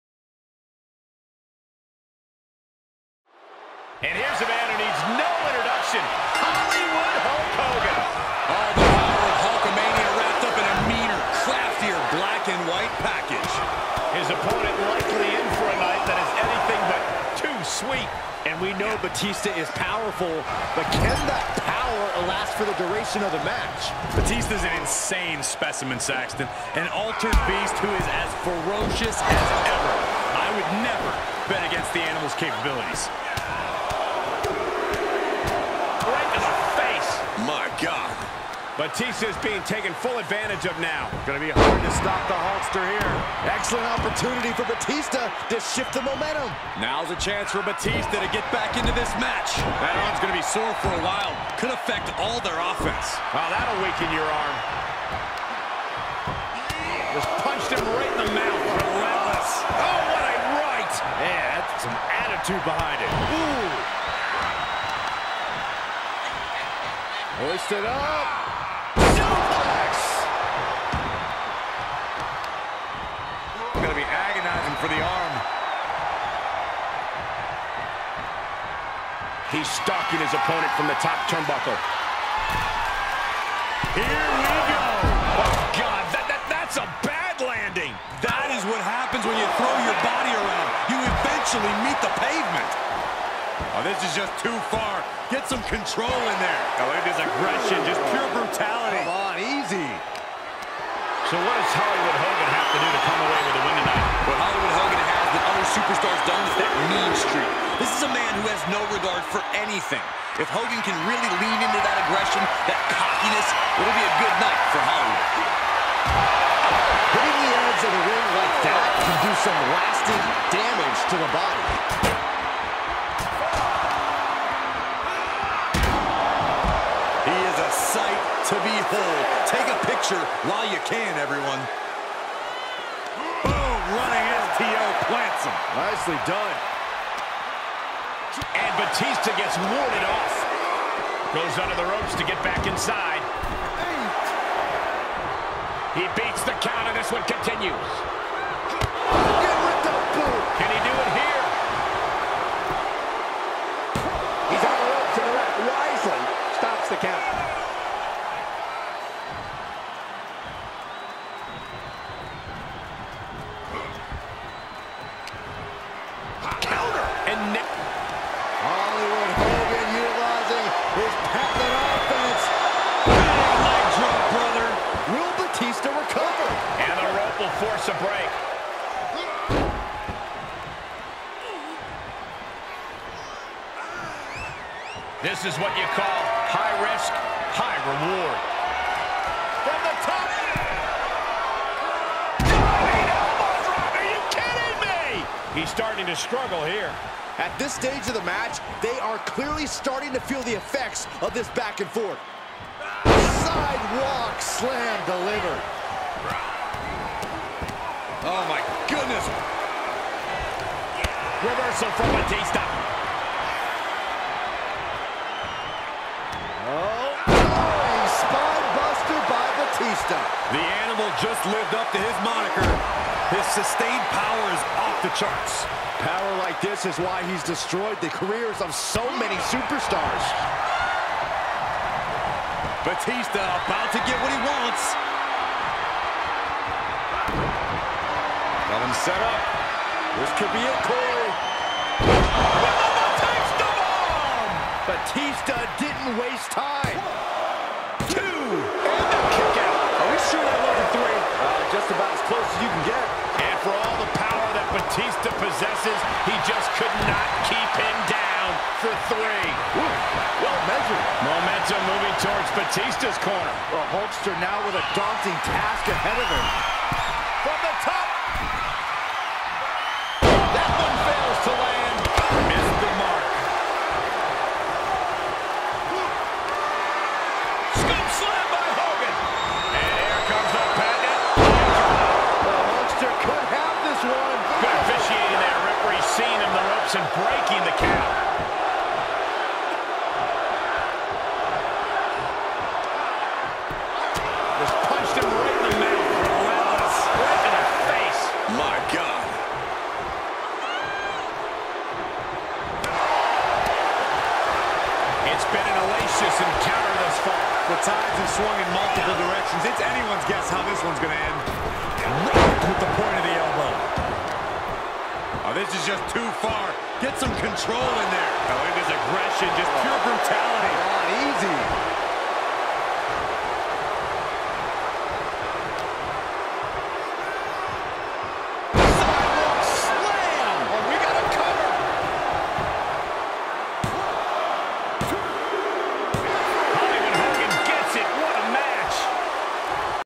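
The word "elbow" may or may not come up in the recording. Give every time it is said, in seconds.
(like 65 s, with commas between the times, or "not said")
313 s.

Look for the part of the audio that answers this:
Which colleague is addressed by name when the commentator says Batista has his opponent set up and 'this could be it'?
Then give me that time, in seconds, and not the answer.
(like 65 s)
240 s.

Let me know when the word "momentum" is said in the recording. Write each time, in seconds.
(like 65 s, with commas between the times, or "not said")
46 s, 261 s.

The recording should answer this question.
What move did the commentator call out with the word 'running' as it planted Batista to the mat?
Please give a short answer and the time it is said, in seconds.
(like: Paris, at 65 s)
STO, at 134 s.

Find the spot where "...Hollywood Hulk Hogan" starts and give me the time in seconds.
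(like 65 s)
6 s.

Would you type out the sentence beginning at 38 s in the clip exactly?
Batista is being taken full advantage of now.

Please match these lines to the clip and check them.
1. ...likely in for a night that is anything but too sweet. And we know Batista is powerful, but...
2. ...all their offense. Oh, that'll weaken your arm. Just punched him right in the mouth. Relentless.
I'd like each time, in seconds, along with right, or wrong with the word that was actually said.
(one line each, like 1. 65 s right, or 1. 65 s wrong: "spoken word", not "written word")
1. 14 s right
2. 52 s right.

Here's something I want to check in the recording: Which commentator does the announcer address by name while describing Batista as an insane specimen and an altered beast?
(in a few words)
Saxton.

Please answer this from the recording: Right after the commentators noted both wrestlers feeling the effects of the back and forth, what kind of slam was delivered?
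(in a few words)
Sidewalk slam.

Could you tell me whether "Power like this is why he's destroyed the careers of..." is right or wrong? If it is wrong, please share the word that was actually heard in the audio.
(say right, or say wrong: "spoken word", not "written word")
right.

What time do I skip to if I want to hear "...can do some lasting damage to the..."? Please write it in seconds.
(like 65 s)
119 s.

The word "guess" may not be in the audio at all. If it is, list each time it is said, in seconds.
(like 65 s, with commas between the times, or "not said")
310 s.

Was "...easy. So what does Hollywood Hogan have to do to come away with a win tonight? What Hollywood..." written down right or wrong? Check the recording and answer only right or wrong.
right.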